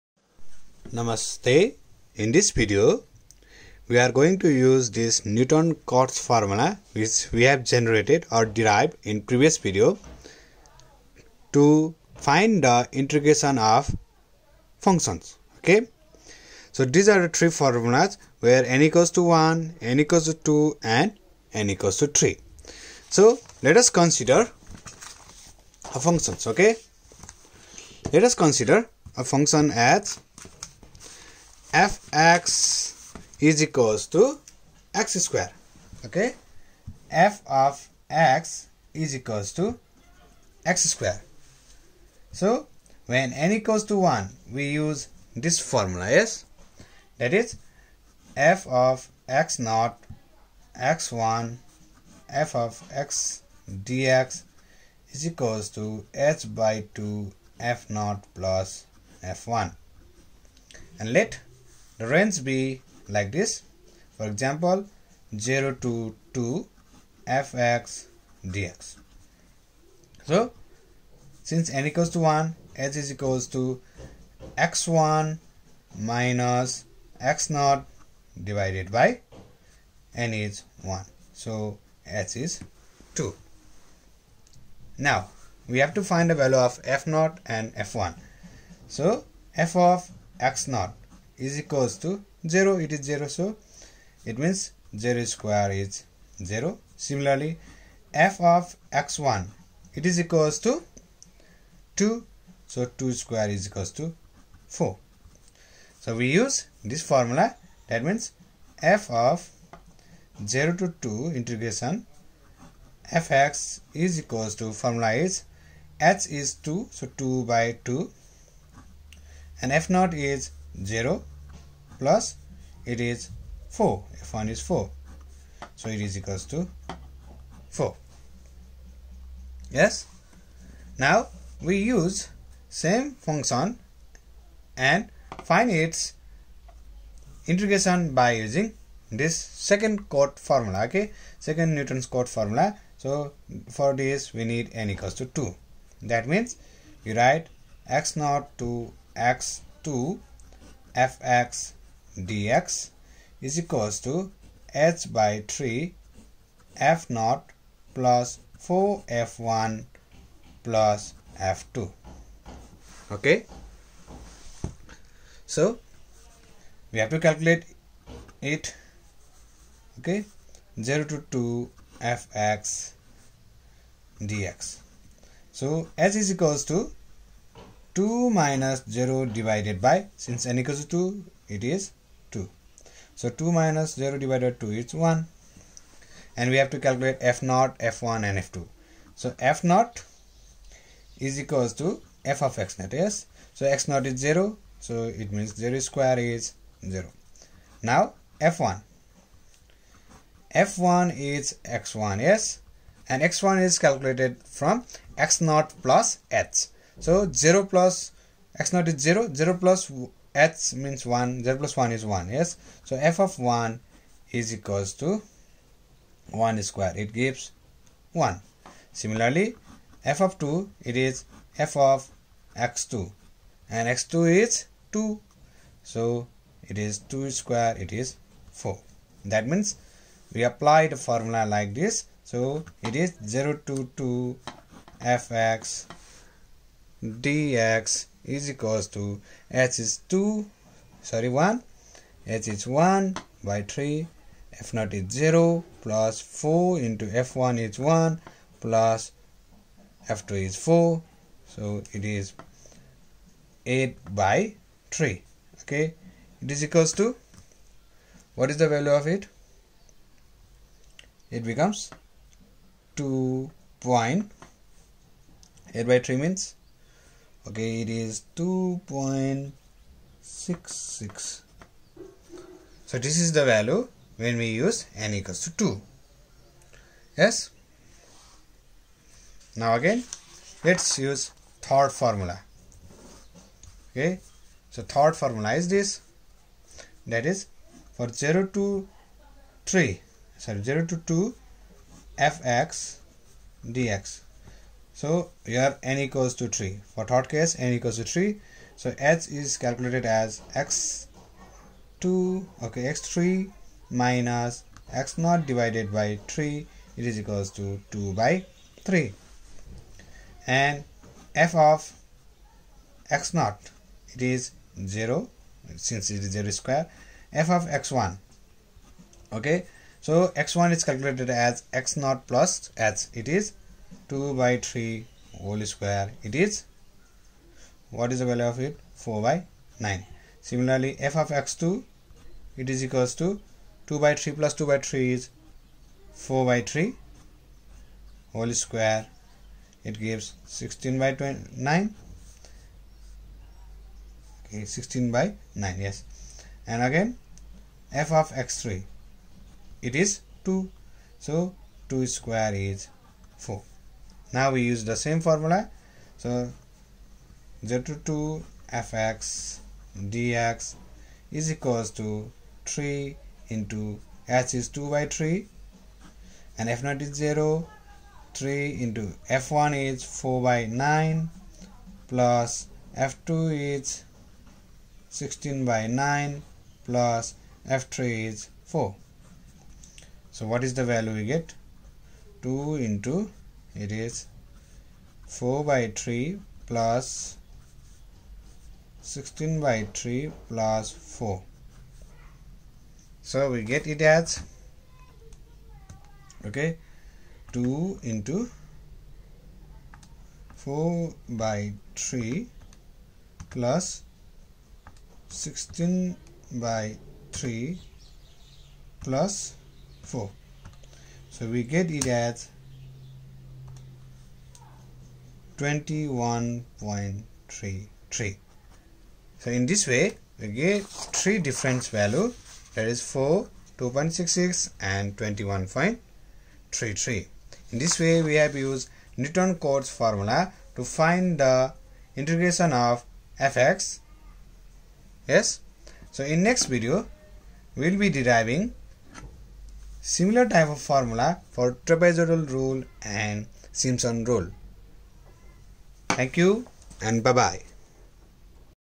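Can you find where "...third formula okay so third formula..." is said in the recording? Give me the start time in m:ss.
4:41.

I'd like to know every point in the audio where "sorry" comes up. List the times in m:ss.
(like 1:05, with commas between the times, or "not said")
4:01, 4:50.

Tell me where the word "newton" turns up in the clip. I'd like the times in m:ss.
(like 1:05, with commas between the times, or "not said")
0:05, 2:21, 7:09.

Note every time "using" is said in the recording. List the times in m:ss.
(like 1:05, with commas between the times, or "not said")
2:18.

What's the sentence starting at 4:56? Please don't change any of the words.
For third case, n equals to 3.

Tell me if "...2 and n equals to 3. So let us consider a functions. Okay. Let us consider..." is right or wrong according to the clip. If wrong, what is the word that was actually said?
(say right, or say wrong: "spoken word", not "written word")
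right.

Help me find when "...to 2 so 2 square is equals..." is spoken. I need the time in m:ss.
1:40.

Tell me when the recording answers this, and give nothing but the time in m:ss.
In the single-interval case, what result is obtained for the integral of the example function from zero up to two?
2:05.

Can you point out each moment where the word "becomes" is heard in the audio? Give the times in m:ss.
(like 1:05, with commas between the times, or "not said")
4:21.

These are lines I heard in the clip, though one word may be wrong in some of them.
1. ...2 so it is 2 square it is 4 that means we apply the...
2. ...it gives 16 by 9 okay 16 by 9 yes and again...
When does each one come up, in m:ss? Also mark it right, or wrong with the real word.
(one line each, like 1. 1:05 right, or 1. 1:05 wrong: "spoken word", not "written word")
1. 3:44 right
2. 5:39 right.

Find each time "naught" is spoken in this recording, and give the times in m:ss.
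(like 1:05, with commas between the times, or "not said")
0:49, 0:57, 1:59, 2:28, 2:37, 4:04.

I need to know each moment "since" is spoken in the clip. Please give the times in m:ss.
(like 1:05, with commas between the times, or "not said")
1:11, 3:00, 5:15.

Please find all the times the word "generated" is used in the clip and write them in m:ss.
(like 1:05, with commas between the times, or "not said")
0:07.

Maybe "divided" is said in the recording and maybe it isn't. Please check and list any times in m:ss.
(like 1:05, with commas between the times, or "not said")
1:18, 2:59, 3:04, 5:05.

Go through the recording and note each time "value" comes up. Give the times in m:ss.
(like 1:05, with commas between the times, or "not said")
1:26, 4:18, 4:33, 5:28, 6:20, 7:01.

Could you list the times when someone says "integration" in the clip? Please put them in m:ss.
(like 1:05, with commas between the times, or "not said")
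0:12, 1:51, 2:17, 7:12.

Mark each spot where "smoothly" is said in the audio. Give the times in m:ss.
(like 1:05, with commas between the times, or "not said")
not said.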